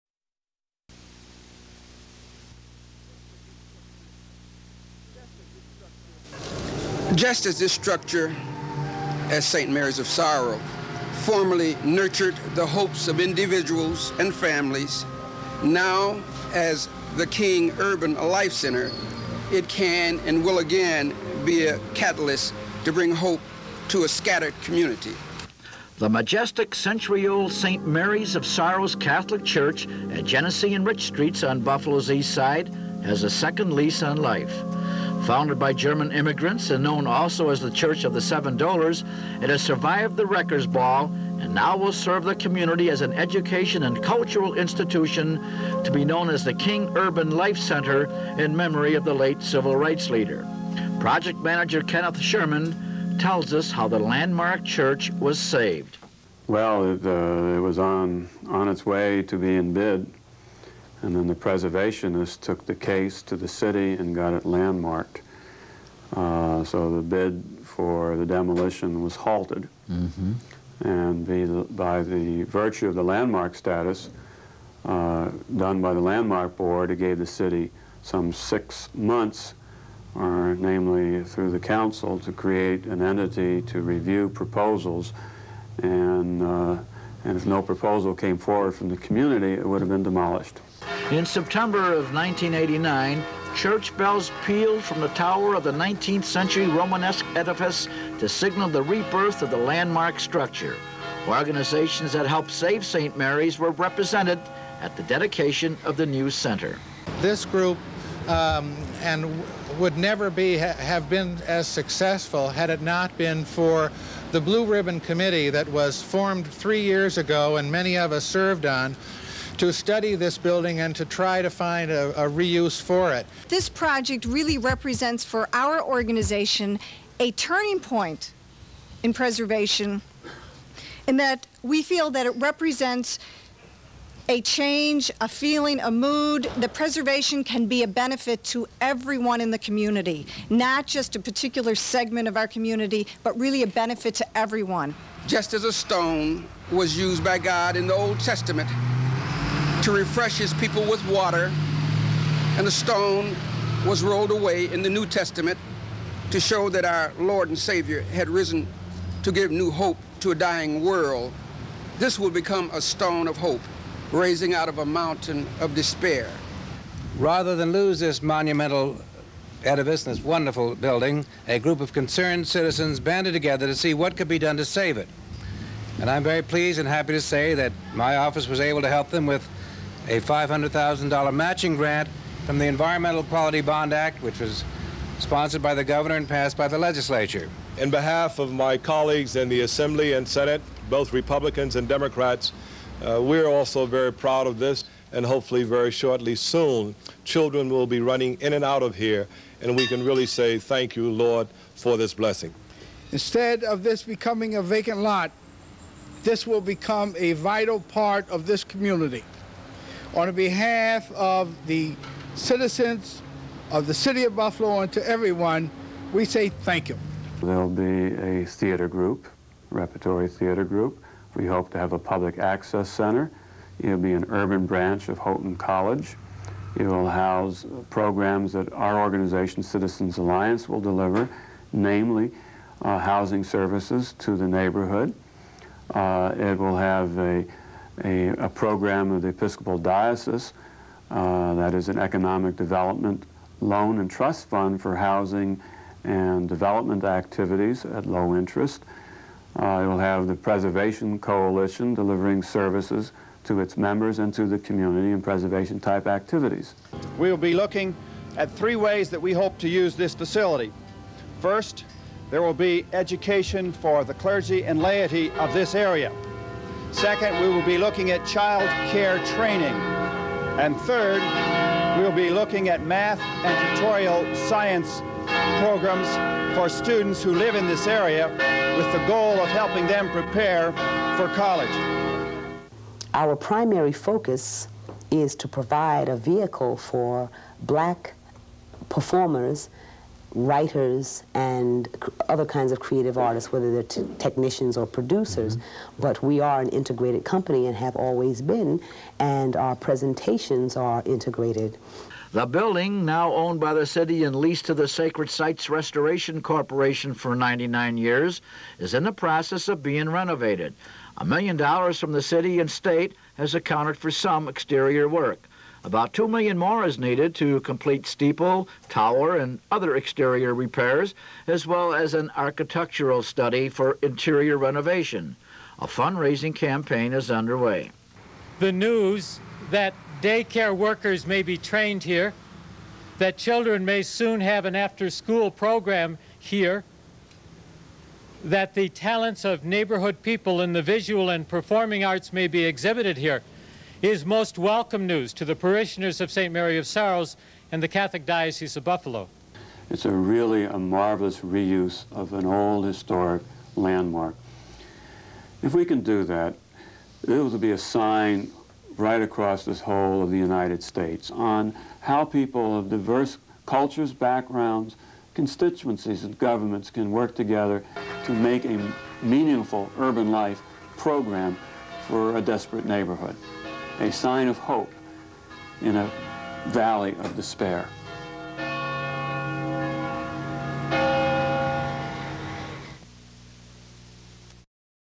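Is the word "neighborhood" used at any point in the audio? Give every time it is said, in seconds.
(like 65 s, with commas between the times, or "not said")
234 s, 339 s, 372 s.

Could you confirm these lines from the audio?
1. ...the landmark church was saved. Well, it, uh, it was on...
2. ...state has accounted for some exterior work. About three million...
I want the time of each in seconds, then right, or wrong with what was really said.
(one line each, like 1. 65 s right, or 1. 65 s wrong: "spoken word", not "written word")
1. 53 s right
2. 312 s wrong: "two", not "three".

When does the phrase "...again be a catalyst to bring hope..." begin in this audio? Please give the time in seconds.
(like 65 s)
20 s.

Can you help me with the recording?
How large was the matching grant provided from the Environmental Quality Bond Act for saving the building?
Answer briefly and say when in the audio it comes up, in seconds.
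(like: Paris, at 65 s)
$500,000, at 180 s.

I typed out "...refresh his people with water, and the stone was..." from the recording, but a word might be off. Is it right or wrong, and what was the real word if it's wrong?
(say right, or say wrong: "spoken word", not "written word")
right.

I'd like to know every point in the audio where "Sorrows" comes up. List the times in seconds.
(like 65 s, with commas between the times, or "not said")
10 s, 28 s, 346 s.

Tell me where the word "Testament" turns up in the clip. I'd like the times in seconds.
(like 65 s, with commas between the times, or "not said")
148 s, 155 s.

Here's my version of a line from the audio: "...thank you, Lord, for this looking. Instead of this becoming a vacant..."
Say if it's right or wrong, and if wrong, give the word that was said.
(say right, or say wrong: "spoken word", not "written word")
wrong: "blessing", not "looking".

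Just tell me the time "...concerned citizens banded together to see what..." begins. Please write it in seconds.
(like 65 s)
171 s.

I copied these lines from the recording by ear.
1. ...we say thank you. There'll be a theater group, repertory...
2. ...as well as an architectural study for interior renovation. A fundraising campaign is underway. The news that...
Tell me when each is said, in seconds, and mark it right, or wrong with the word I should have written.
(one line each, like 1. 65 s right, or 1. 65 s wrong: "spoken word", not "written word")
1. 216 s right
2. 321 s right.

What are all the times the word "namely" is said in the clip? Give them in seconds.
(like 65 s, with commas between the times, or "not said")
80 s, 231 s.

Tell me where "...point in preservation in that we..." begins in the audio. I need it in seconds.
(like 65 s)
127 s.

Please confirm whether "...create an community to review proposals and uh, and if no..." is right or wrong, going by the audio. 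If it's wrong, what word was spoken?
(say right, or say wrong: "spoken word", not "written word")
wrong: "entity", not "community".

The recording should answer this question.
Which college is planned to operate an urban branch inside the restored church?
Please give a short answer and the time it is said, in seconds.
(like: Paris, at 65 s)
Houghton College, at 225 s.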